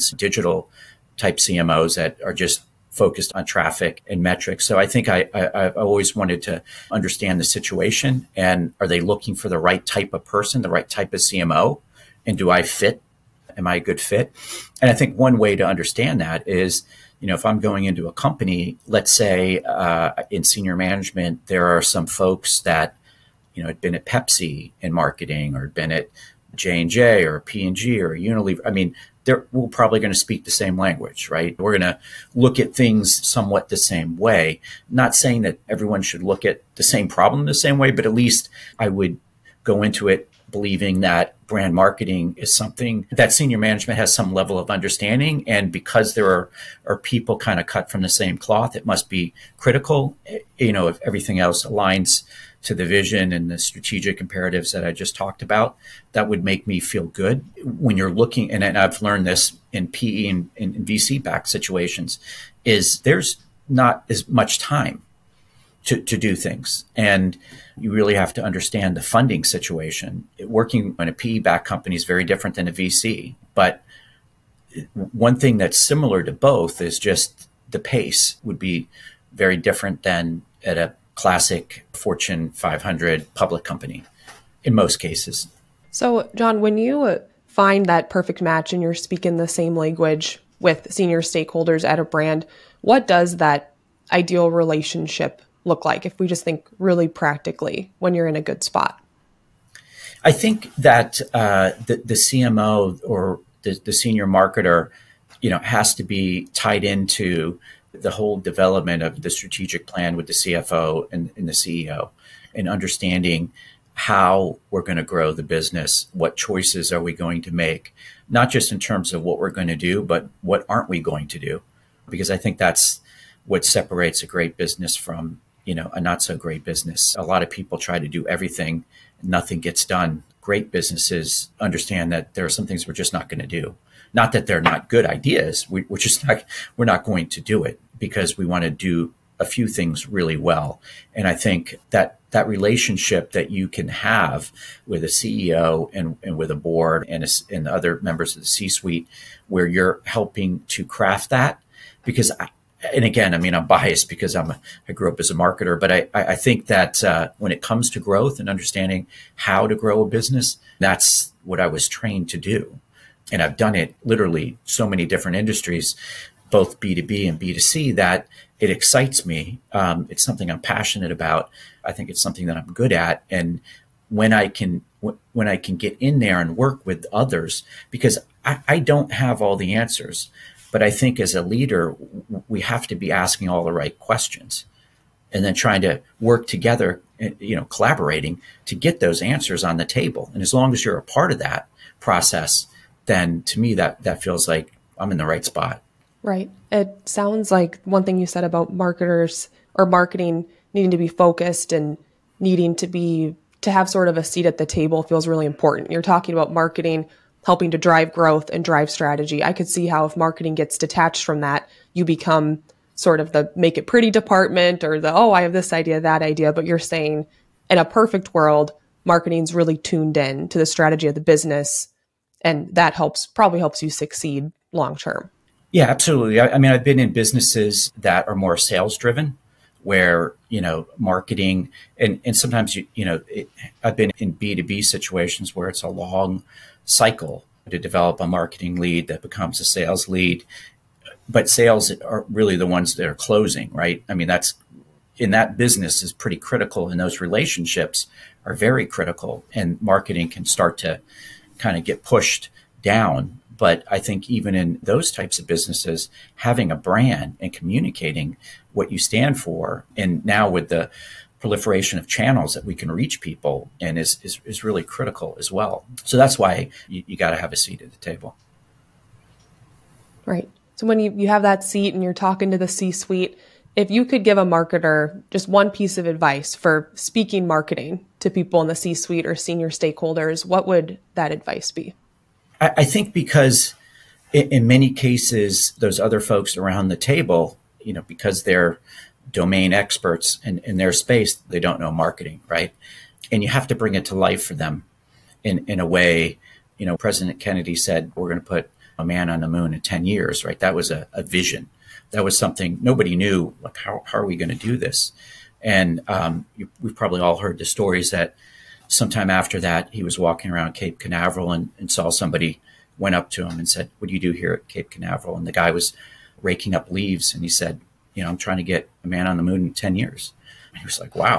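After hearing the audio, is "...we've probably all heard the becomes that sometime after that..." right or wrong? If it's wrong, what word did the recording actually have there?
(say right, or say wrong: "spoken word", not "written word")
wrong: "stories", not "becomes".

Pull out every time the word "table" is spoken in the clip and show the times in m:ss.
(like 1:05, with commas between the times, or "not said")
3:09, 3:24, 4:27, 4:46.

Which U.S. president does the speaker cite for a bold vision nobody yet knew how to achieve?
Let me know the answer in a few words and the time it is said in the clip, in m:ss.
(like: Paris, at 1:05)
President Kennedy, at 4:56.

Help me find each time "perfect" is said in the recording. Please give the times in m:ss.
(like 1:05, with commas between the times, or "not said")
1:28, 3:37.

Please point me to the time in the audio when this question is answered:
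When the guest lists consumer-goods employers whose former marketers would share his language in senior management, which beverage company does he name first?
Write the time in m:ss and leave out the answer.
0:24.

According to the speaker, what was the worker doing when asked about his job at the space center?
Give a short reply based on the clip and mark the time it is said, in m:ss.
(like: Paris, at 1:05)
raking up leaves, at 5:16.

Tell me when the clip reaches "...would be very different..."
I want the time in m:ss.
1:18.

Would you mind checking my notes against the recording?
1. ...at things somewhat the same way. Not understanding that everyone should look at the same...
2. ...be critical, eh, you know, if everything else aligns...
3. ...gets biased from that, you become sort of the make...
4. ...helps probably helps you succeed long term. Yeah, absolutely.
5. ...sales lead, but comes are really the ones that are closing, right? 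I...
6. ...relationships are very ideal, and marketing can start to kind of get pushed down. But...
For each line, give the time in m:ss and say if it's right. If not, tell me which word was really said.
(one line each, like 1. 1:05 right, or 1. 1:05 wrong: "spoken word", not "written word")
1. 0:32 wrong: "saying", not "understanding"
2. 0:49 right
3. 3:30 wrong: "detached", not "biased"
4. 3:42 right
5. 3:59 wrong: "sales", not "comes"
6. 4:07 wrong: "critical", not "ideal".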